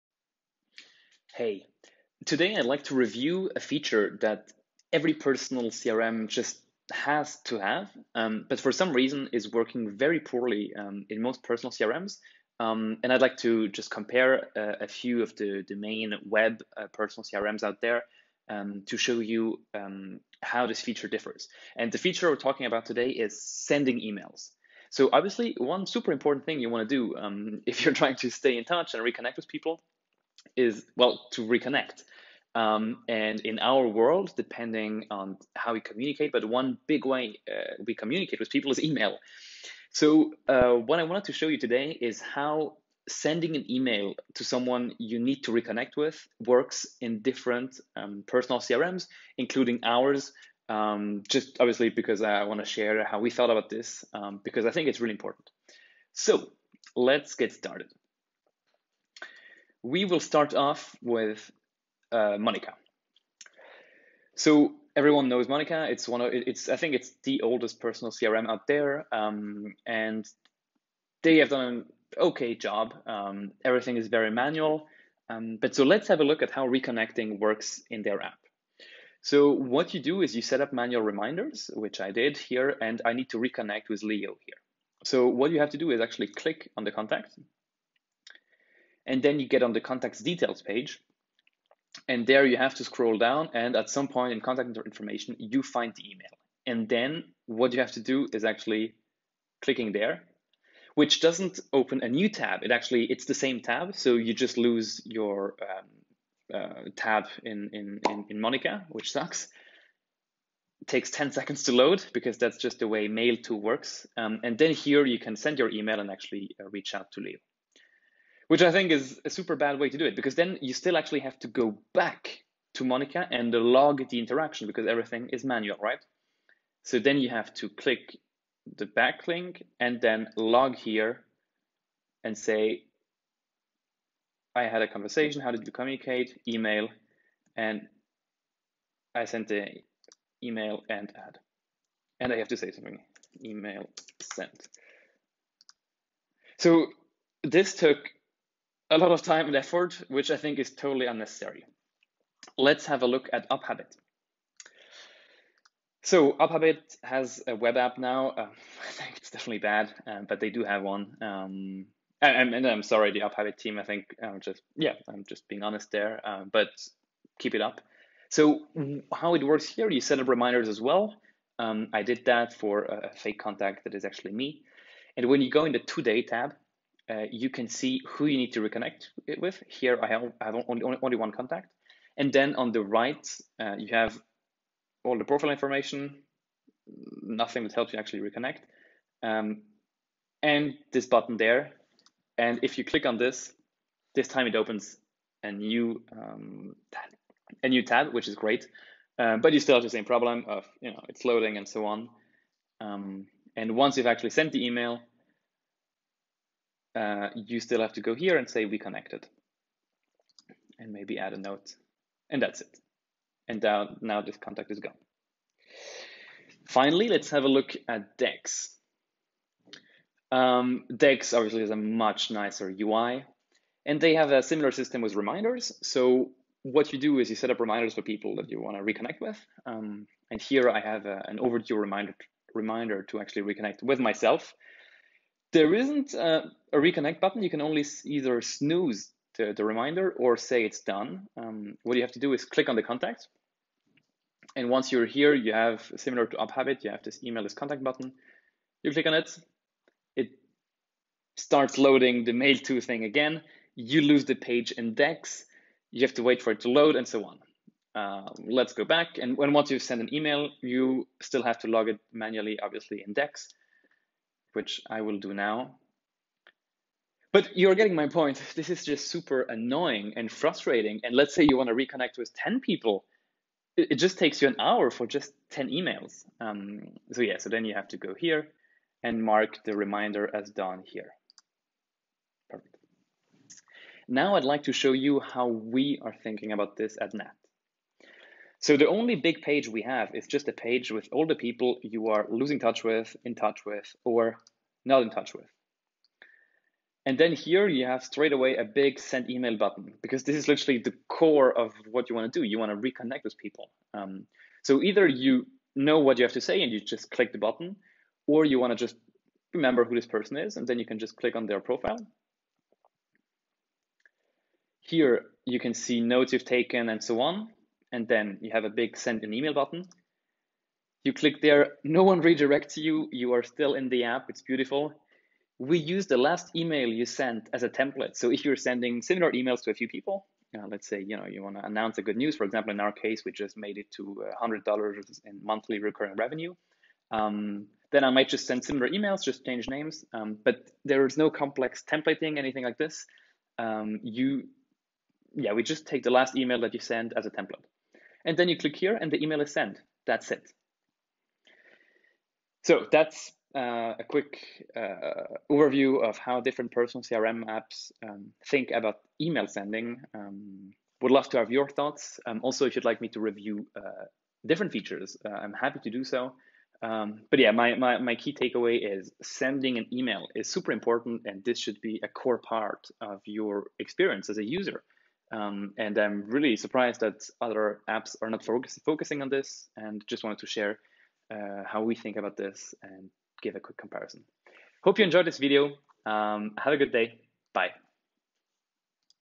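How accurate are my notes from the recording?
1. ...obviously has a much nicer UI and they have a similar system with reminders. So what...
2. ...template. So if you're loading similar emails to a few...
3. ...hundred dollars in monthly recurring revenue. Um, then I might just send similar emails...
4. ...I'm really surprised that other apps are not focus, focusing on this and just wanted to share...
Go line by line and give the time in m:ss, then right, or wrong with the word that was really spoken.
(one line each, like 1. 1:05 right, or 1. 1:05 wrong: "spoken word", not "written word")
1. 3:41 right
2. 5:27 wrong: "sending", not "loading"
3. 5:34 right
4. 6:15 right.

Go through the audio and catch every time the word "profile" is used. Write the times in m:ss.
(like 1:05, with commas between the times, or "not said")
3:05, 5:11.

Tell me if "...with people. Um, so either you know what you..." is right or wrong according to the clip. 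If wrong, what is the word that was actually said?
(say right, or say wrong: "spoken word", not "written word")
right.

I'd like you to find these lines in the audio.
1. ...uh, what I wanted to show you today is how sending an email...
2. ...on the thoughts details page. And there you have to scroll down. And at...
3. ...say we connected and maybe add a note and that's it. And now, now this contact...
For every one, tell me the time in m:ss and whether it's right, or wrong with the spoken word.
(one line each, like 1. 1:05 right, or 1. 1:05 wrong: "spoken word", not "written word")
1. 0:40 right
2. 1:29 wrong: "contacts", not "thoughts"
3. 3:28 right.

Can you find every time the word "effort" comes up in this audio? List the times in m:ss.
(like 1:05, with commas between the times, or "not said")
2:29.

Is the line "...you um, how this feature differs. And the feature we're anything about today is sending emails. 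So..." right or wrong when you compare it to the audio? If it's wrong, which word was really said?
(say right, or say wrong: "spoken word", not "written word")
wrong: "talking", not "anything".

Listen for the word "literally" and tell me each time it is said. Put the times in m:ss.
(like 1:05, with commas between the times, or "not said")
5:00.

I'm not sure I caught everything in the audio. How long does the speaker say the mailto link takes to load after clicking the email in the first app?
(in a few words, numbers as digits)
10 seconds.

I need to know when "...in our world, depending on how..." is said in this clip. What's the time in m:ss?
0:33.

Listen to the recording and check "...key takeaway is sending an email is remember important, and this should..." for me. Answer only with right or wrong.
wrong.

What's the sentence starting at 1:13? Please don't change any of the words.
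Um, everything is very manual, um, but so let's have a look at how reconnecting works in their app.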